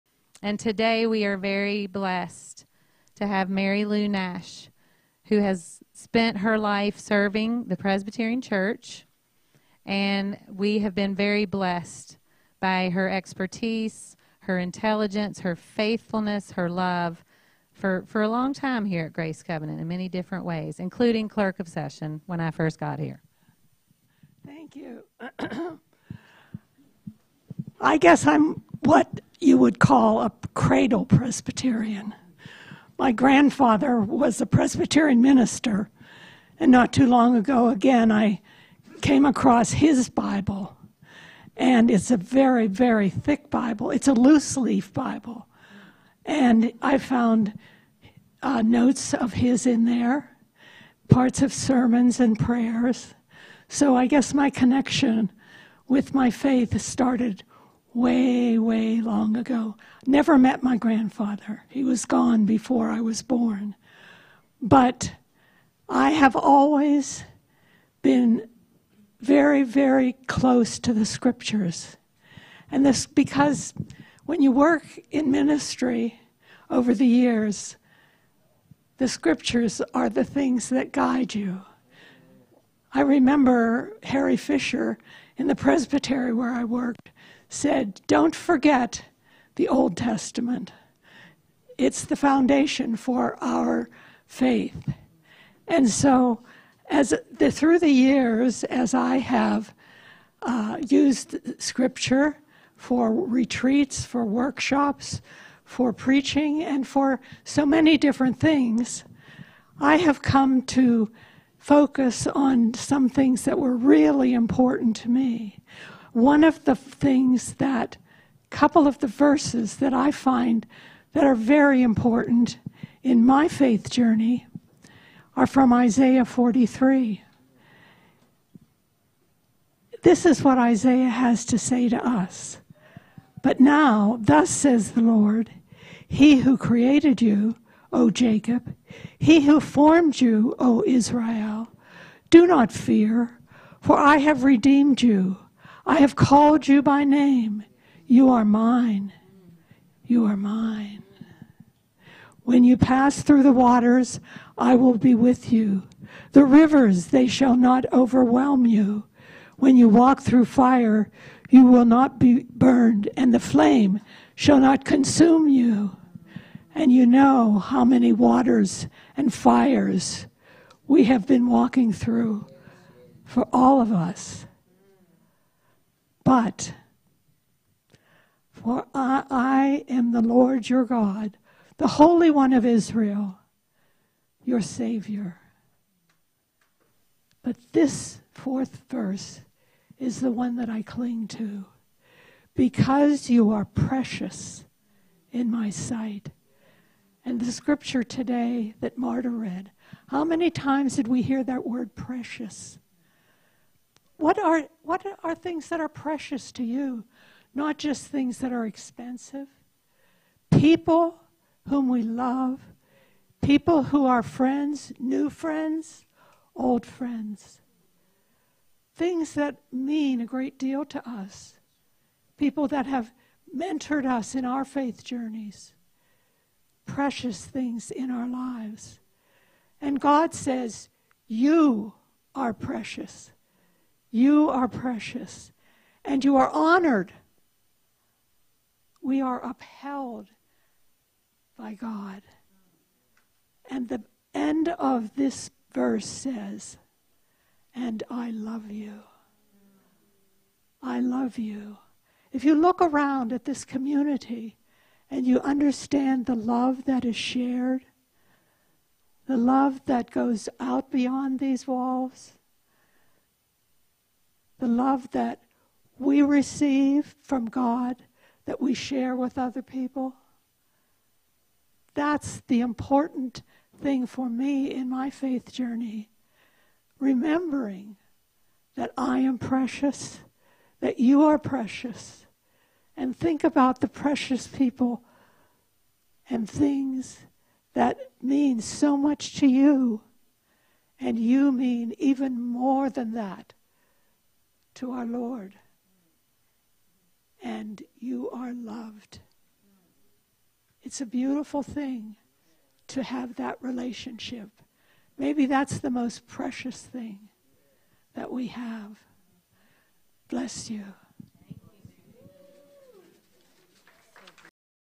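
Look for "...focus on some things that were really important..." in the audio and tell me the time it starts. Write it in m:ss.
1:51.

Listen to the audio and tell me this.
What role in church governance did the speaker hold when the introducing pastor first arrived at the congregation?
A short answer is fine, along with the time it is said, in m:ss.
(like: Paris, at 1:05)
Clerk of session, at 0:21.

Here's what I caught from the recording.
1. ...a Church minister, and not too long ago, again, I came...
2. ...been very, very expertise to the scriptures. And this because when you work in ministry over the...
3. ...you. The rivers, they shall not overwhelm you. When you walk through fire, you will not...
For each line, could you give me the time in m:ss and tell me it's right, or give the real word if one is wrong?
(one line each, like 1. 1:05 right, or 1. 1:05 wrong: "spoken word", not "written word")
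1. 0:34 wrong: "Presbyterian", not "Church"
2. 1:08 wrong: "close", not "expertise"
3. 2:35 right.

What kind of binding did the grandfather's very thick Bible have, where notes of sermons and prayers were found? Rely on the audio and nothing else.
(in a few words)
Loose leaf.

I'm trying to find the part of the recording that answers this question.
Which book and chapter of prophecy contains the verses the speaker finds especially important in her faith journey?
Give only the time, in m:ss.
2:05.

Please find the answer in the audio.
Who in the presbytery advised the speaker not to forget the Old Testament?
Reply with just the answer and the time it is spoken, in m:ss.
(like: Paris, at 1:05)
Harry Fisher, at 1:24.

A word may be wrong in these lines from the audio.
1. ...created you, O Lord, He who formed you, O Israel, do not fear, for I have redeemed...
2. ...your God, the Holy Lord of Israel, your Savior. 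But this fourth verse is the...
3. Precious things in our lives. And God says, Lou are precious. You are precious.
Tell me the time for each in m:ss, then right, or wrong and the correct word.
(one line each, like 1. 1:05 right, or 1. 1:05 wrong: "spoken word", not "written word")
1. 2:16 wrong: "Jacob", not "Lord"
2. 3:00 wrong: "One", not "Lord"
3. 3:46 wrong: "You", not "Lou".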